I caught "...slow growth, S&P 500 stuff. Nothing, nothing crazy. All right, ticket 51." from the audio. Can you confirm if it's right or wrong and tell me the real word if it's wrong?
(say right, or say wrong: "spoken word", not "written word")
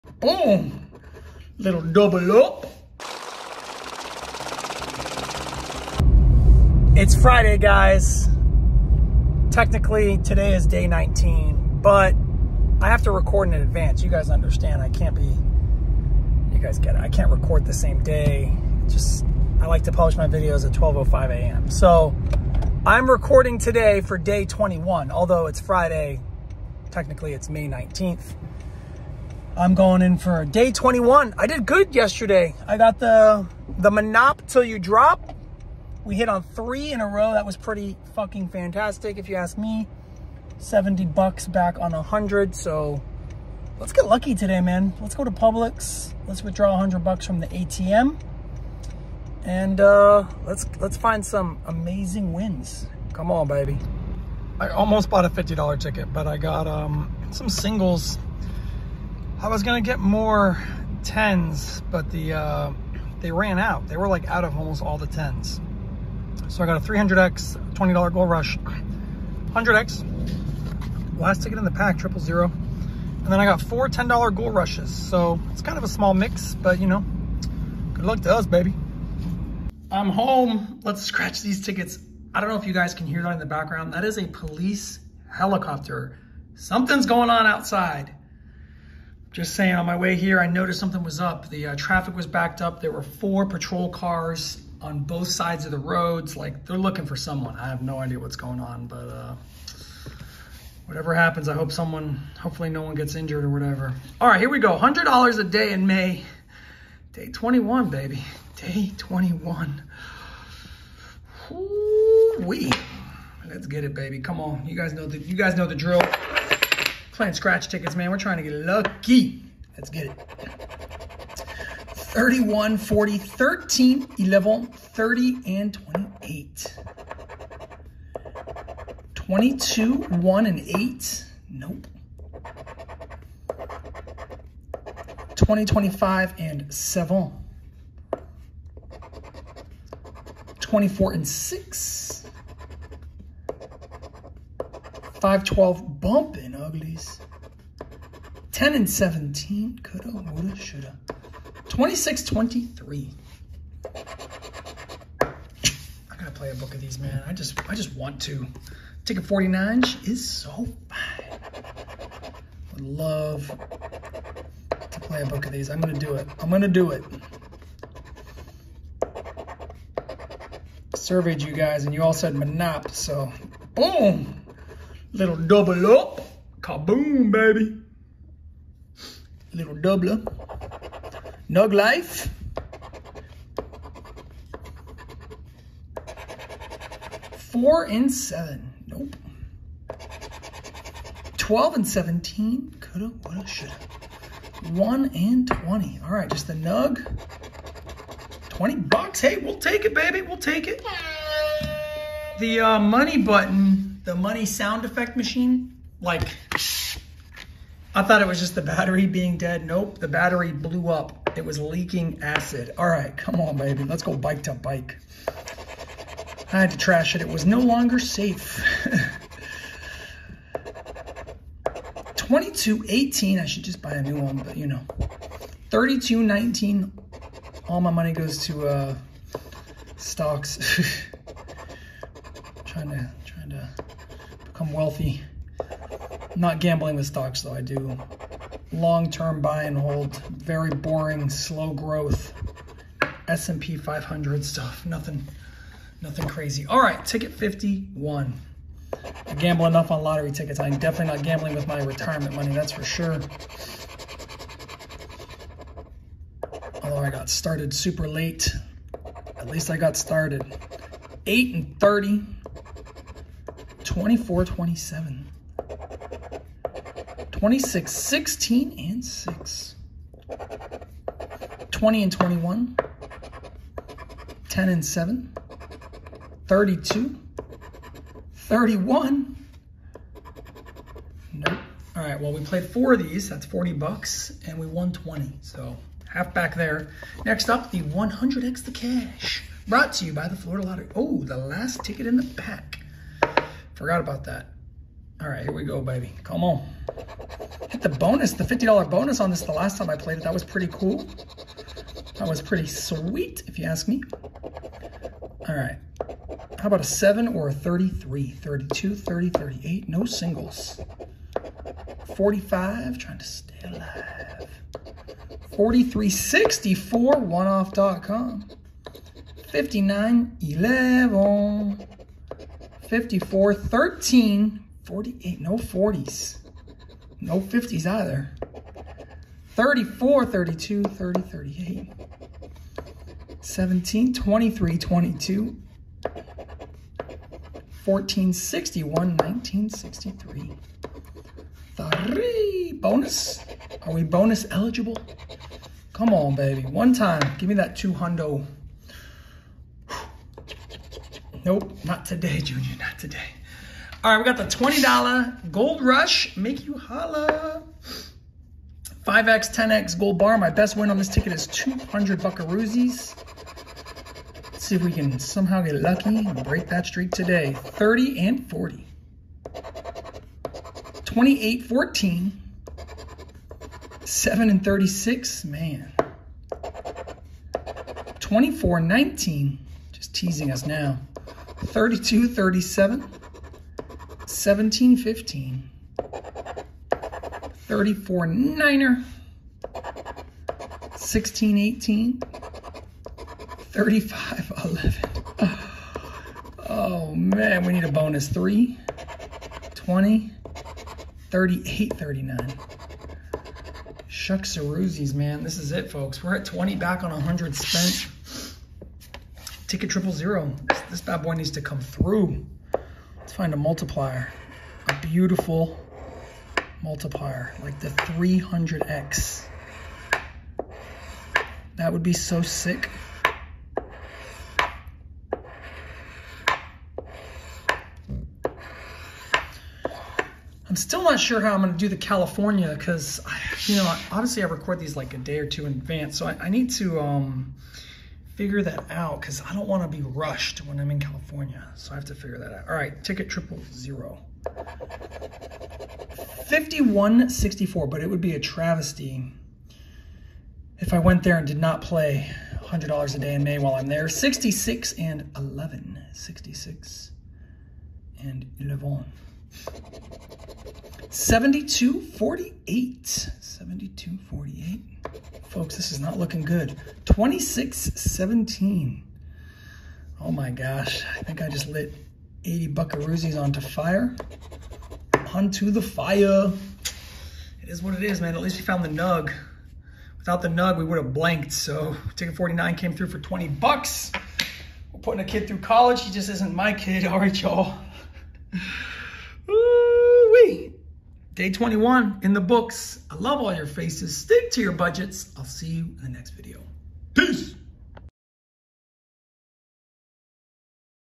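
right.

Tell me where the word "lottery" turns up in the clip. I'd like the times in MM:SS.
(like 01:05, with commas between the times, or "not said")
04:10, 04:50.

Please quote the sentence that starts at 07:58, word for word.
At least we found the nug.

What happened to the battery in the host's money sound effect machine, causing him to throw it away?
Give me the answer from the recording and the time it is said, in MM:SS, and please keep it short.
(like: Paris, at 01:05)
blew up, at 03:29.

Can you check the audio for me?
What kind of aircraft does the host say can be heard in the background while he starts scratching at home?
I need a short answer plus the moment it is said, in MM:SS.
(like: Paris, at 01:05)
police helicopter, at 01:24.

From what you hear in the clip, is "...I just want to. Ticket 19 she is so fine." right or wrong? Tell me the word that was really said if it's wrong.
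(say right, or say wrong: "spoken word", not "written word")
wrong: "49", not "19".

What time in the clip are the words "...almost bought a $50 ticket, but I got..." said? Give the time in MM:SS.
00:54.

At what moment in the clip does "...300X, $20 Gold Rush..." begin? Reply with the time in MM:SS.
01:06.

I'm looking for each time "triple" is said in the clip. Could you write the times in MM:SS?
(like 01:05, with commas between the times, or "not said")
01:11, 06:49, 07:23.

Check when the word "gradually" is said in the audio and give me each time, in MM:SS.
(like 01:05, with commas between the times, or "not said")
not said.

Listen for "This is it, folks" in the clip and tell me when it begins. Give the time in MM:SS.
06:45.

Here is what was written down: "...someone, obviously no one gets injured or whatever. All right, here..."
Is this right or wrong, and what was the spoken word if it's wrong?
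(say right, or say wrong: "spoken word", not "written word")
wrong: "hopefully", not "obviously".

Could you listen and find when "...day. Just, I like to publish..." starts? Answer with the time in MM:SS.
00:18.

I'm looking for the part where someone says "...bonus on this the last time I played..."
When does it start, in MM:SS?
04:58.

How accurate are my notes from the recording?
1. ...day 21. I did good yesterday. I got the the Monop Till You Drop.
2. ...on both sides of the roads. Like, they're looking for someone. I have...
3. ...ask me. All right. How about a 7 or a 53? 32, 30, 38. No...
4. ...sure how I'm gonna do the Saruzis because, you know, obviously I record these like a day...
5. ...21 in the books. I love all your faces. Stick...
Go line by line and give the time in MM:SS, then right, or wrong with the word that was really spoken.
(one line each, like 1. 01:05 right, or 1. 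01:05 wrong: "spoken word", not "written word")
1. 00:30 right
2. 01:34 right
3. 05:03 wrong: "33", not "53"
4. 07:11 wrong: "California", not "Saruzis"
5. 08:11 right.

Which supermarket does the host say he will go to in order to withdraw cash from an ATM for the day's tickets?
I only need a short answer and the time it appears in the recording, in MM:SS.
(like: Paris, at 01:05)
Publix, at 00:45.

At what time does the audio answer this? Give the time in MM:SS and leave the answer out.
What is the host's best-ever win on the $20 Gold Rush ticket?
06:01.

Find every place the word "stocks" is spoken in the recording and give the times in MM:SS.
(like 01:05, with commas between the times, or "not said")
03:49, 03:57.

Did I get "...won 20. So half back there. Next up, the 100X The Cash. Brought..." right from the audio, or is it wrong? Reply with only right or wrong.
right.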